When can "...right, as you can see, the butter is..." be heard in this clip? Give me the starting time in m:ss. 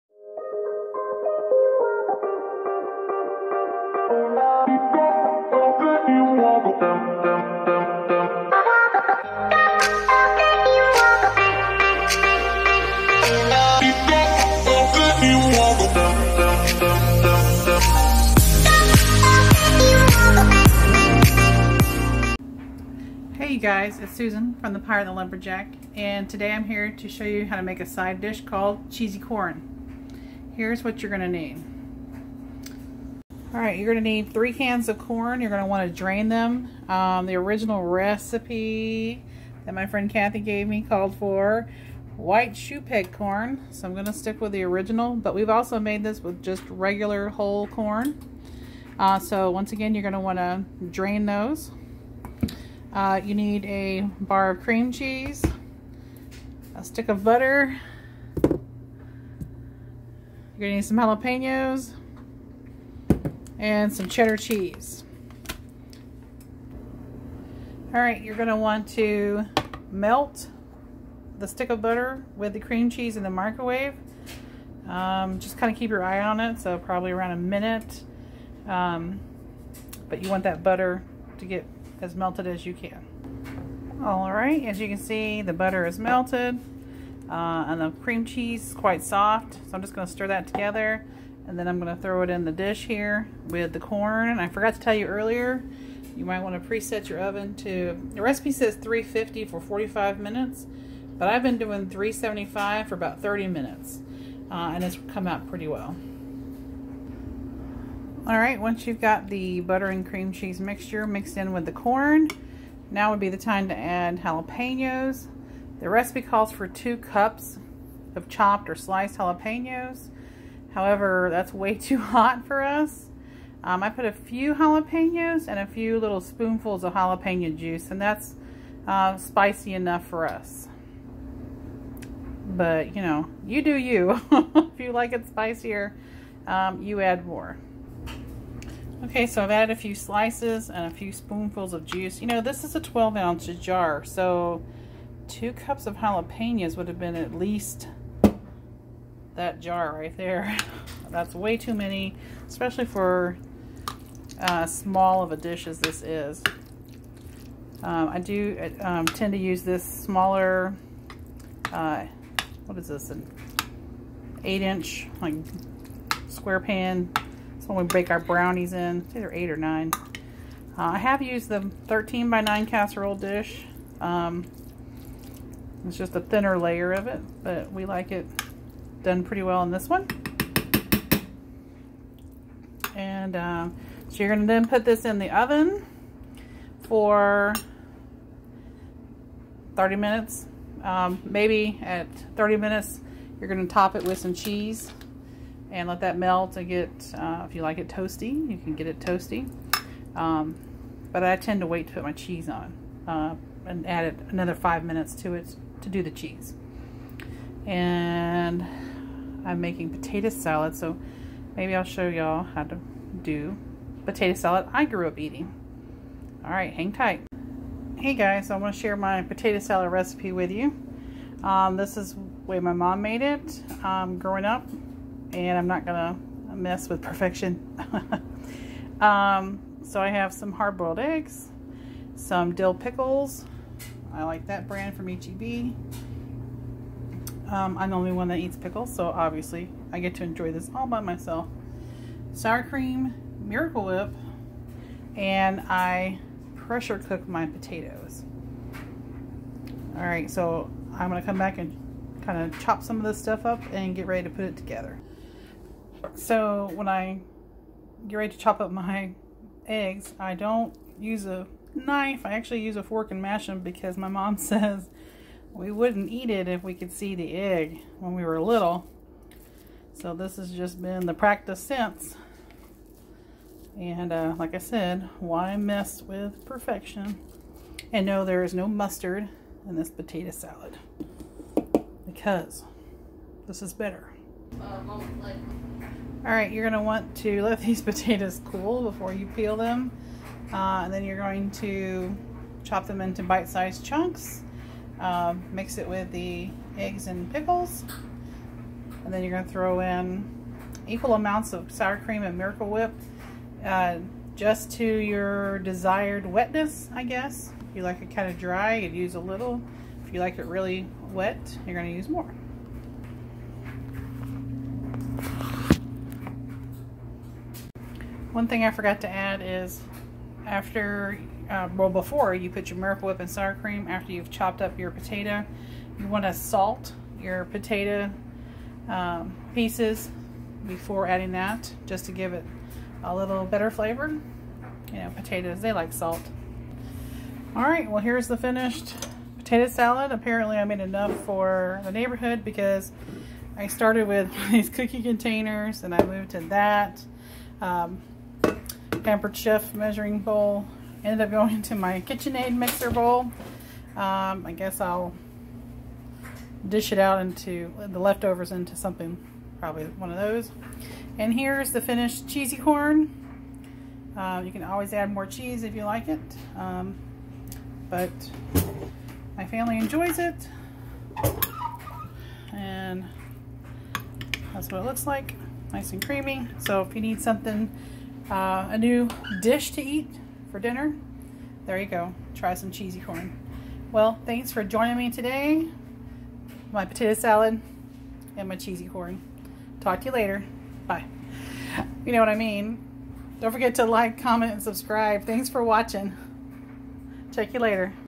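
1:24.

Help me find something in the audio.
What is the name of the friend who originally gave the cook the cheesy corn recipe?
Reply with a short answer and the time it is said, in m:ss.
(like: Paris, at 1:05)
Kathy, at 0:40.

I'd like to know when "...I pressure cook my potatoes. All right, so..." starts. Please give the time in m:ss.
4:05.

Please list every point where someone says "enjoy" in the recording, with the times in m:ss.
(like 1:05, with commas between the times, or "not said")
4:00, 6:09.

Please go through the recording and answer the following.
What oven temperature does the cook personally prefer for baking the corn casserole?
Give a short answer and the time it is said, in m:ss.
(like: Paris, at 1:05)
375, at 1:41.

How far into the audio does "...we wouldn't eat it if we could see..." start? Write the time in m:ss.
4:25.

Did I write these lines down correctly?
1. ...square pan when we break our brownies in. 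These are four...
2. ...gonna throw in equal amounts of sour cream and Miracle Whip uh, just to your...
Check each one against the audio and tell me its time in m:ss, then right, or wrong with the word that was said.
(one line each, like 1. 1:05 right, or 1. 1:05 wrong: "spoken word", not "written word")
1. 2:46 wrong: "eight", not "four"
2. 4:59 right.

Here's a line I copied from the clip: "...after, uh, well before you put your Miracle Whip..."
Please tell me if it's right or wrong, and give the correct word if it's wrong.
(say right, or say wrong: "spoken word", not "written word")
right.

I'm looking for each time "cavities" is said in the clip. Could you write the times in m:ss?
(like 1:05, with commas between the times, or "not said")
not said.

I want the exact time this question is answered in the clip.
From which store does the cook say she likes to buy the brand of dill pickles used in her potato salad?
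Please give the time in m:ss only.
3:55.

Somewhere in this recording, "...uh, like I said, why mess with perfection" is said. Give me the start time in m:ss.
4:34.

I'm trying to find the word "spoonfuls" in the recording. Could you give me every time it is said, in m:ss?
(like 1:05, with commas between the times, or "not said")
2:06, 2:21.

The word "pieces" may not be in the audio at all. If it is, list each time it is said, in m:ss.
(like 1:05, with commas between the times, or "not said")
5:29.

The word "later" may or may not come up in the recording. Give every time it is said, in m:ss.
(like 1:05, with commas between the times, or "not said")
6:30, 6:37.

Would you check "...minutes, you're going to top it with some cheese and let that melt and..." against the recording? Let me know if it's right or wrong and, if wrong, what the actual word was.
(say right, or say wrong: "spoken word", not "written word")
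right.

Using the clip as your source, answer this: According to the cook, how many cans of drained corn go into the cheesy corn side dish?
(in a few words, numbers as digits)
3.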